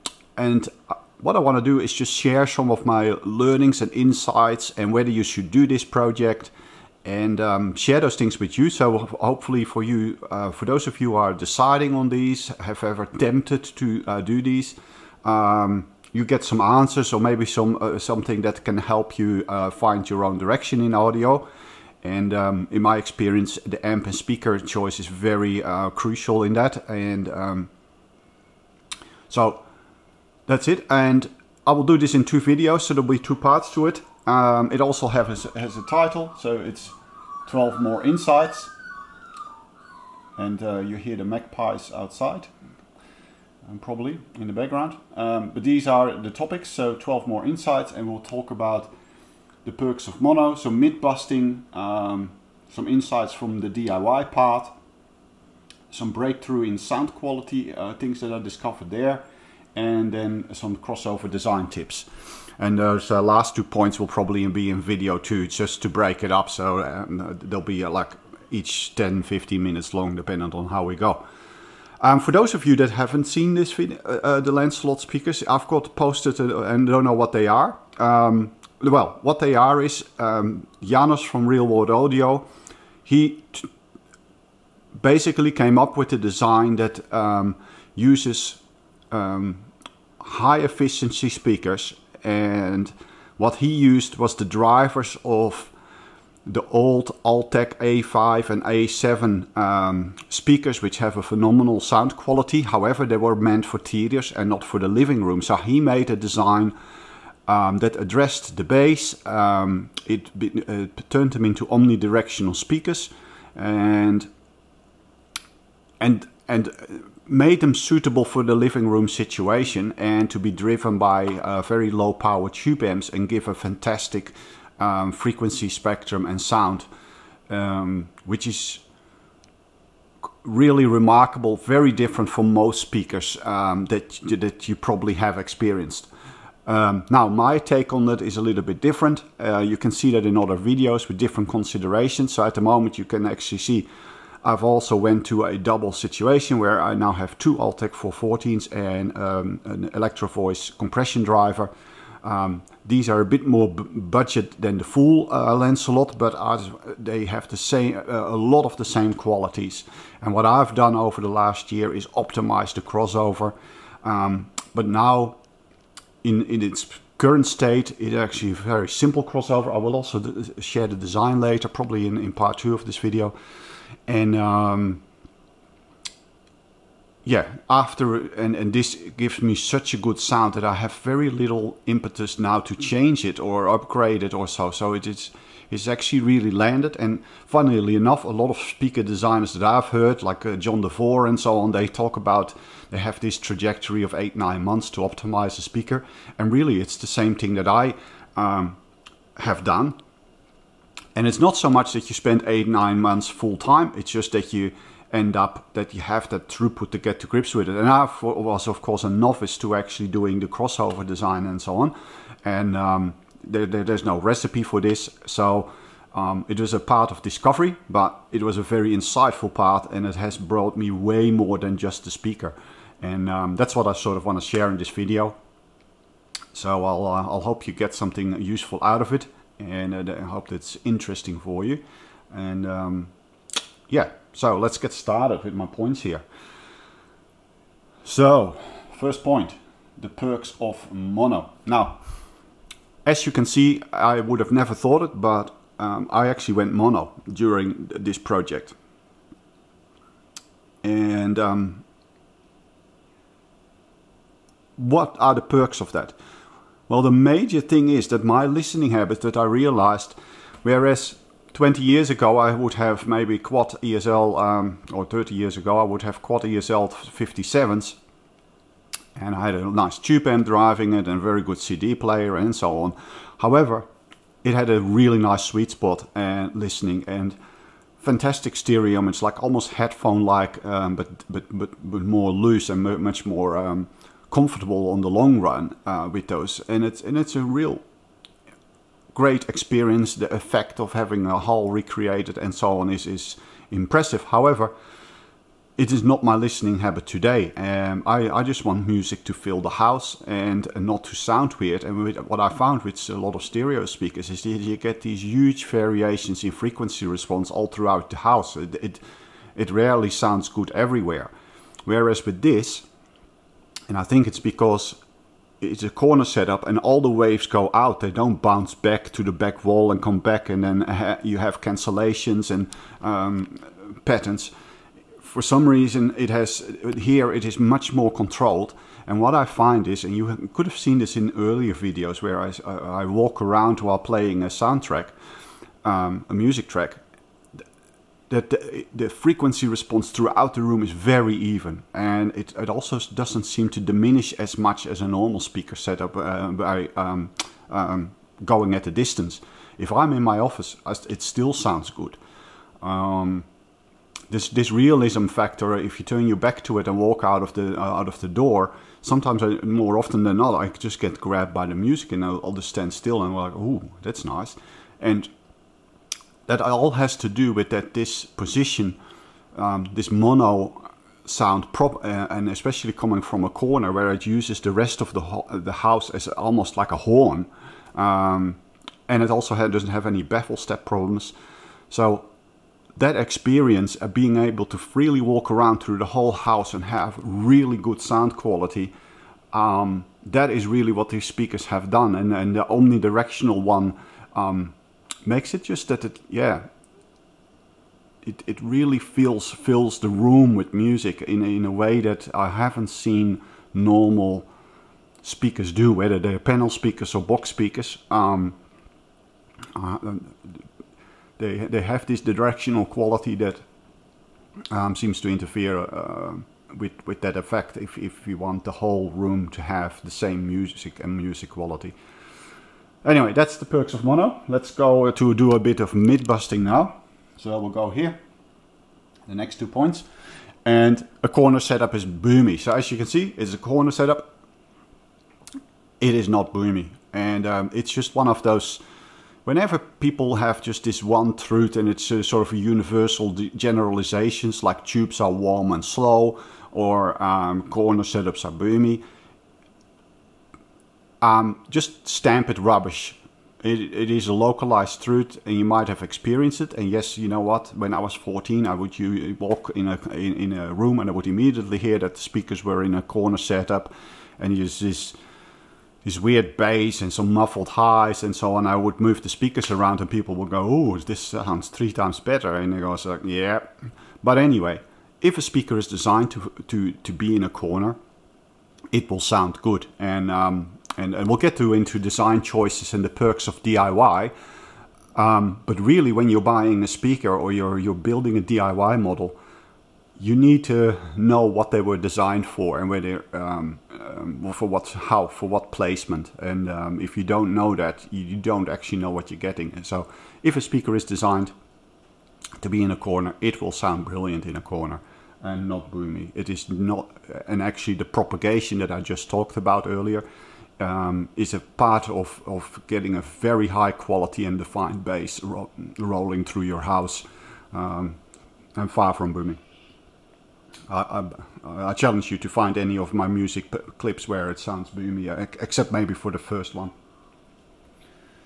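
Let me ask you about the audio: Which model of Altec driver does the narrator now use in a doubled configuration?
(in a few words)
Altec 414.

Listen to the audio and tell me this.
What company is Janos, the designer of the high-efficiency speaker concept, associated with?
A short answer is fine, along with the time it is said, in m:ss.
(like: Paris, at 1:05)
Real World Audio, at 1:21.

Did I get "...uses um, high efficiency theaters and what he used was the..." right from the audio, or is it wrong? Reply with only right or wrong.
wrong.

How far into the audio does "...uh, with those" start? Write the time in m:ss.
4:45.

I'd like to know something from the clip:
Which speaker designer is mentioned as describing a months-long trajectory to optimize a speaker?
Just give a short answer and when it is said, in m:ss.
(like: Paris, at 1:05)
John DeVore, at 3:10.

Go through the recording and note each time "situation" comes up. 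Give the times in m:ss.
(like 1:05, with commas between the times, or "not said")
1:59, 2:25.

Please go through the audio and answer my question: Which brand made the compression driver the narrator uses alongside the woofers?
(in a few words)
Electrovoice.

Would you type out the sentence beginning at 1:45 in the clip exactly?
So he made a design um, that addressed the bass.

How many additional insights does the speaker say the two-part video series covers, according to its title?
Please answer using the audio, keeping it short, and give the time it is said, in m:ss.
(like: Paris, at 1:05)
12, at 0:37.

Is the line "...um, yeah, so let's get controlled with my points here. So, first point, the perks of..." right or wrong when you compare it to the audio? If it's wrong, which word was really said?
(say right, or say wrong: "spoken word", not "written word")
wrong: "started", not "controlled".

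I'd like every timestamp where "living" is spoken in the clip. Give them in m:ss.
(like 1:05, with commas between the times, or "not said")
1:44, 1:58.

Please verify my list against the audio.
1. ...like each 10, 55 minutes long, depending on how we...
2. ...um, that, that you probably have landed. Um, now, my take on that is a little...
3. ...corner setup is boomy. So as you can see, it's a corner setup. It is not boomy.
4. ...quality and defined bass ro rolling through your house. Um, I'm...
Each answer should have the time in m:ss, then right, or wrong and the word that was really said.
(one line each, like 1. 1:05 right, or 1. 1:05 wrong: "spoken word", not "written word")
1. 1:07 wrong: "15", not "55"
2. 2:13 wrong: "experienced", not "landed"
3. 7:11 right
4. 8:33 right.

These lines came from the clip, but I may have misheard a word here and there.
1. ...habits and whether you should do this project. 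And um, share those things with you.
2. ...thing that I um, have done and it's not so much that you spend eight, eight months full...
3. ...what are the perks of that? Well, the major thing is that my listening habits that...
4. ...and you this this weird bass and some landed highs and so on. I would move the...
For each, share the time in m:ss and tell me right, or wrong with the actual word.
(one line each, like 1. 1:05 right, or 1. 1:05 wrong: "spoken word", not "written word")
1. 0:03 wrong: "insights", not "habits"
2. 3:17 wrong: "nine", not "eight"
3. 4:14 right
4. 7:44 wrong: "muffled", not "landed".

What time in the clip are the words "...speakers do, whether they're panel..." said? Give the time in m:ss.
6:45.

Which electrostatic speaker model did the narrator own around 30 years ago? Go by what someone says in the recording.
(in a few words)
Quad ESL 57.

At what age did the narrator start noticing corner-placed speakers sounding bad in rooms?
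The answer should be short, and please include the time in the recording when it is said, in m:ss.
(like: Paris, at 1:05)
14, at 7:38.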